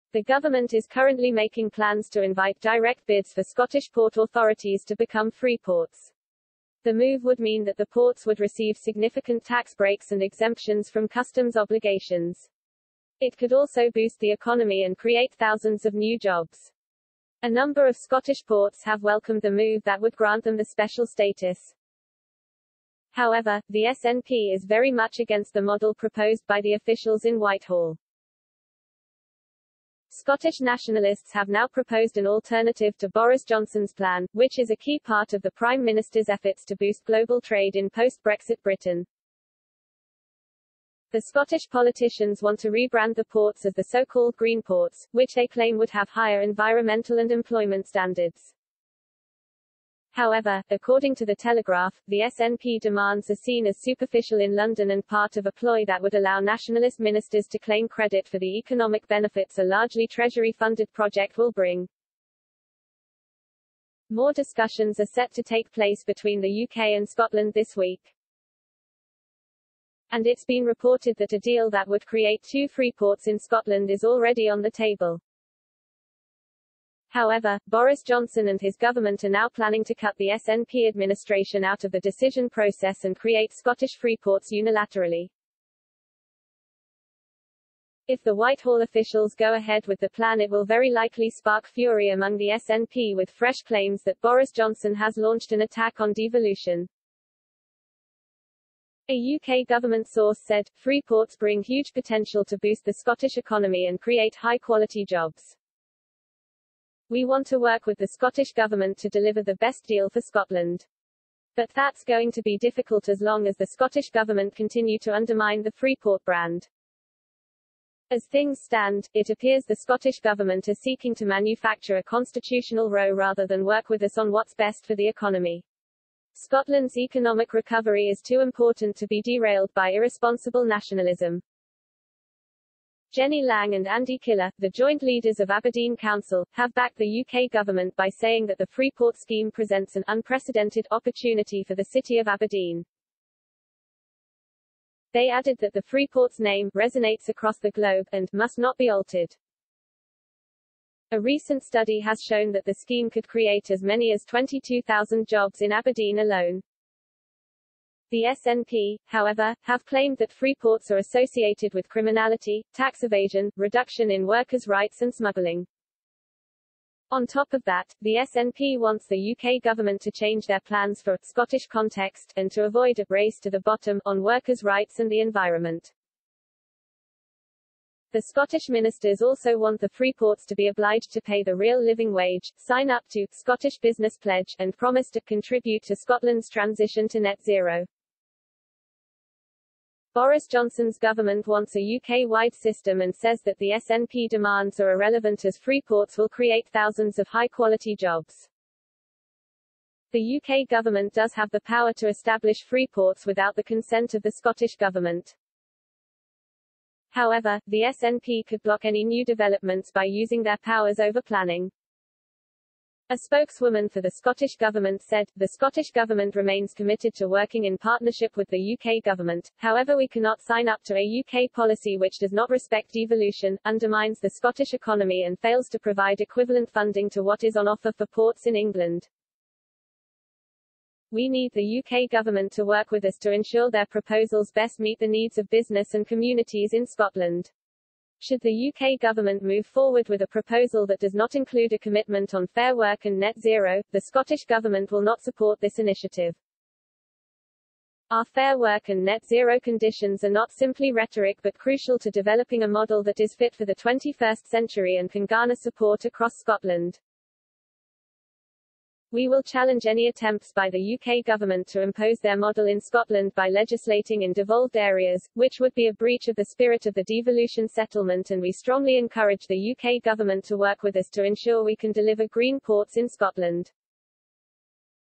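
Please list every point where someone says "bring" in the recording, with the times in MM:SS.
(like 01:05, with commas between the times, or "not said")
01:01, 01:41.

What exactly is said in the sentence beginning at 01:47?
We want to work with the Scottish Government to deliver the best deal for Scotland.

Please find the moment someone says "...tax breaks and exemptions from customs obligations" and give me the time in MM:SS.
00:09.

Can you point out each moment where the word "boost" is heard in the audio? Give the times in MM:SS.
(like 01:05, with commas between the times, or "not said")
00:13, 00:36, 01:42.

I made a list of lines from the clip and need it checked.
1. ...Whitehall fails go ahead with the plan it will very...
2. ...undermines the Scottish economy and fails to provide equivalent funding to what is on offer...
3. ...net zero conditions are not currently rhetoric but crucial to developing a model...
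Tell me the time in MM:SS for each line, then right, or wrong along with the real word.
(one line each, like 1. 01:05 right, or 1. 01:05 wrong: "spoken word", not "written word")
1. 01:28 wrong: "officials", not "fails"
2. 03:43 right
3. 04:09 wrong: "simply", not "currently".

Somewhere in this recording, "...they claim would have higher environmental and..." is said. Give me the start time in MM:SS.
00:45.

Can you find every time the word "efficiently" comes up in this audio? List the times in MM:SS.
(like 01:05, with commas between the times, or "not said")
not said.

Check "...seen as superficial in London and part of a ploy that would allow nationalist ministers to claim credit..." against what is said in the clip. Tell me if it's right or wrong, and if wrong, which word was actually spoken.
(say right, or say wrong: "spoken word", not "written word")
right.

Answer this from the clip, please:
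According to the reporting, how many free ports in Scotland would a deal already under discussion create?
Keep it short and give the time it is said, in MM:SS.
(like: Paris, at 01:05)
2, at 01:12.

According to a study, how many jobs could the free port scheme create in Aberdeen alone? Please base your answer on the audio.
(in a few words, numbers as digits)
22,000.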